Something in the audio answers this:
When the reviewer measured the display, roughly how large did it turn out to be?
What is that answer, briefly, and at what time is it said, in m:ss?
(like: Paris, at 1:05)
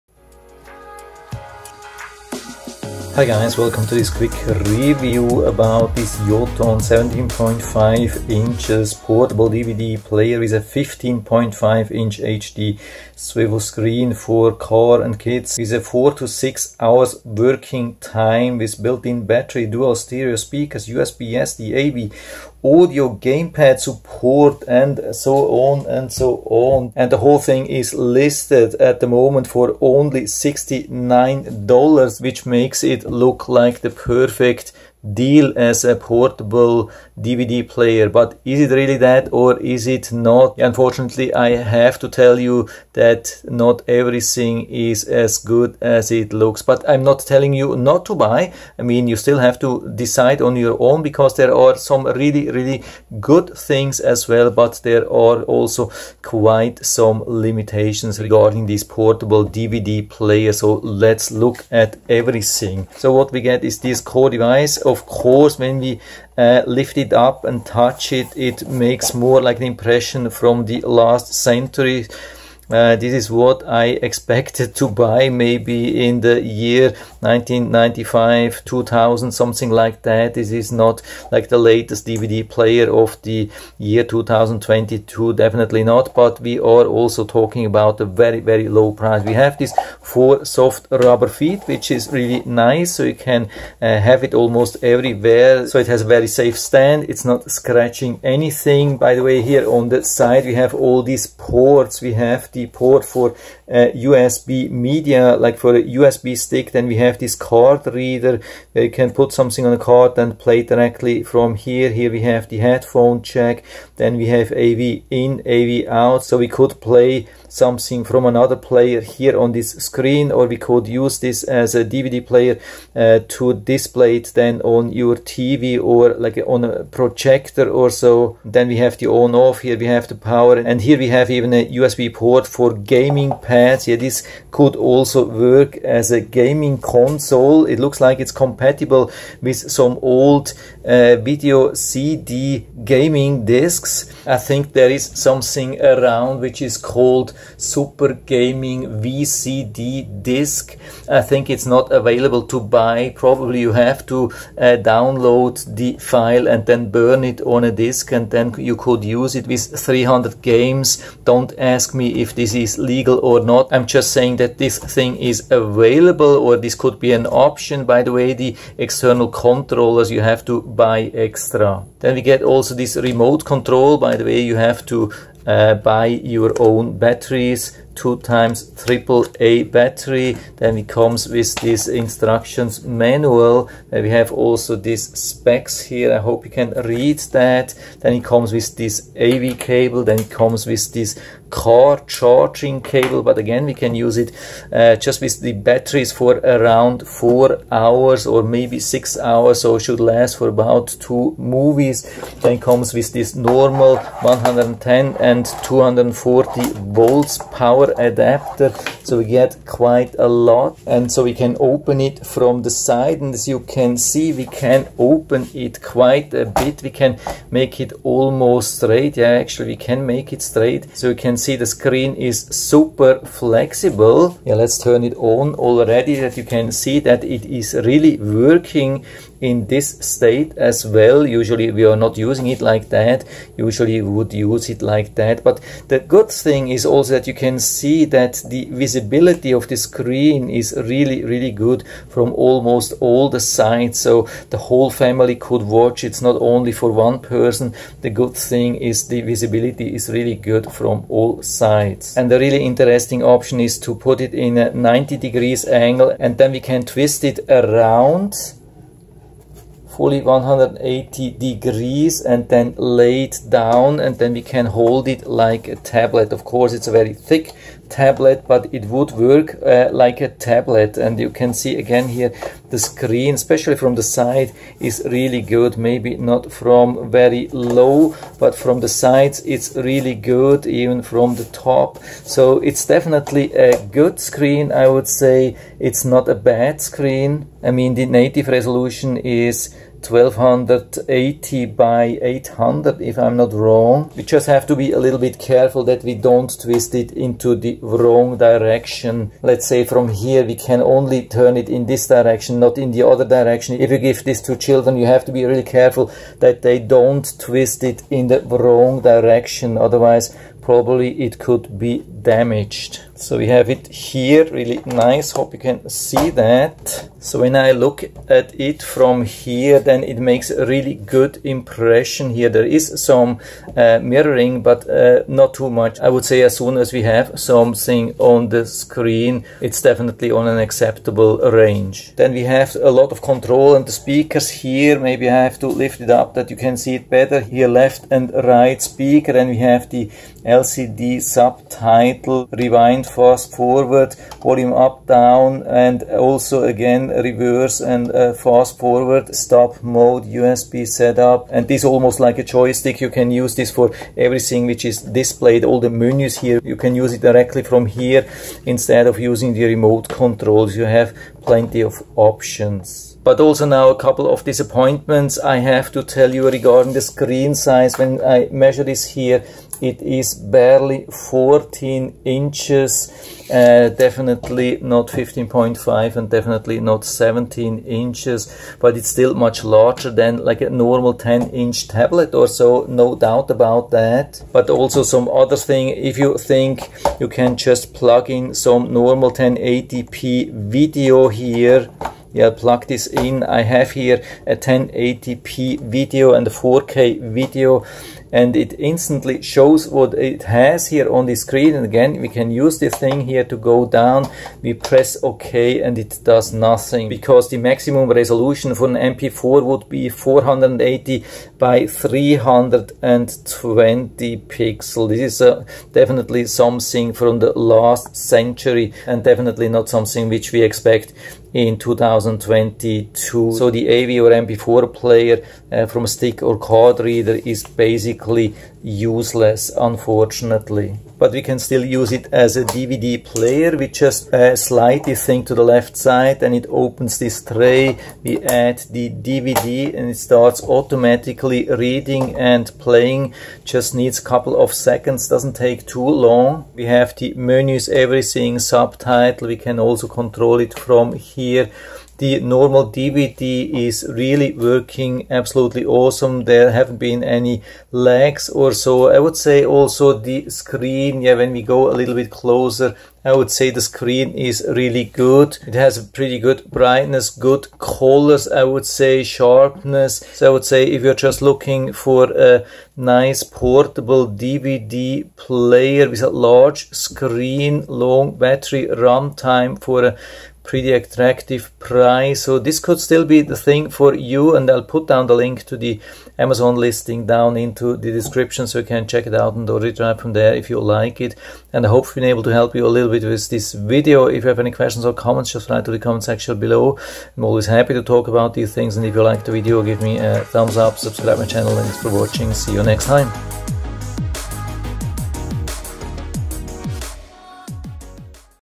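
14 inches, at 6:11.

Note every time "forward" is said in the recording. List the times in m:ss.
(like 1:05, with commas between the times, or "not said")
5:43, 5:48.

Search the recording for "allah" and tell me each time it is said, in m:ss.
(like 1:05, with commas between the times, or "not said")
not said.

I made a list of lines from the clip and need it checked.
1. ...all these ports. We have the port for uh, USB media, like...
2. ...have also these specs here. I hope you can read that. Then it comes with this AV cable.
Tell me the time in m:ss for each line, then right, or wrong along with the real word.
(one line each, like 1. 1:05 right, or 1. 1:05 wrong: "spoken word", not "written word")
1. 1:40 right
2. 3:04 right.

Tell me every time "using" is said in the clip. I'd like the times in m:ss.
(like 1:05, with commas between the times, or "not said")
3:52, 5:59.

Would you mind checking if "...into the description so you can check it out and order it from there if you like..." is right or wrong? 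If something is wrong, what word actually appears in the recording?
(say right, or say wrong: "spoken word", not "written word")
right.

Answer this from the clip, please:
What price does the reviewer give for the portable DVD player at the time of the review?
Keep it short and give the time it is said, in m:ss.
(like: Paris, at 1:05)
$69, at 0:30.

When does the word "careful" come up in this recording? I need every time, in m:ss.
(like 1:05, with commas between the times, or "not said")
4:55, 5:05.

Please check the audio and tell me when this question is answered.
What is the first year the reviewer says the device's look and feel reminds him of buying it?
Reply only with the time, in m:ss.
1:17.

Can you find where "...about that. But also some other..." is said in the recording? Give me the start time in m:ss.
6:23.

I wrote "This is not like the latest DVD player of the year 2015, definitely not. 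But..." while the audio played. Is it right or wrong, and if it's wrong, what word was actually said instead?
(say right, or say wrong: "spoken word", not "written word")
wrong: "2022", not "2015".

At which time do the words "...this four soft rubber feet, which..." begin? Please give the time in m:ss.
1:29.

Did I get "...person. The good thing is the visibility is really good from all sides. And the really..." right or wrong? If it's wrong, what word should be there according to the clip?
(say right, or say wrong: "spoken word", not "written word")
right.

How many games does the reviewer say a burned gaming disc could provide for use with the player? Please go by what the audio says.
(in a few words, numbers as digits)
300.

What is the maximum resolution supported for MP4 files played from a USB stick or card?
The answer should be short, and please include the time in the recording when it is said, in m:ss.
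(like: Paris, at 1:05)
480 by 320, at 6:50.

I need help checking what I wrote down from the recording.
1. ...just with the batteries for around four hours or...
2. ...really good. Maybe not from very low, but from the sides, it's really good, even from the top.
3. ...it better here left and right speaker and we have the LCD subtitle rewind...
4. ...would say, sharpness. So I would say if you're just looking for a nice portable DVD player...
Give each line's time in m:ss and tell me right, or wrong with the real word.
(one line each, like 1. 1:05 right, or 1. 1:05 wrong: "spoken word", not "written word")
1. 3:14 right
2. 4:35 right
3. 5:36 right
4. 7:48 right.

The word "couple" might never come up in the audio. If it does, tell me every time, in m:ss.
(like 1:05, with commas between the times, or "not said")
6:03, 7:24.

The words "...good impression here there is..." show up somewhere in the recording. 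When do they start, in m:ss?
5:20.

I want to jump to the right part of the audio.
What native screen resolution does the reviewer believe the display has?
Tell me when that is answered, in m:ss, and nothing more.
4:50.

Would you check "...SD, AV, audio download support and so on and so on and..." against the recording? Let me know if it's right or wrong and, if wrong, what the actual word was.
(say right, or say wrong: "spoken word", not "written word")
wrong: "gamepad", not "download".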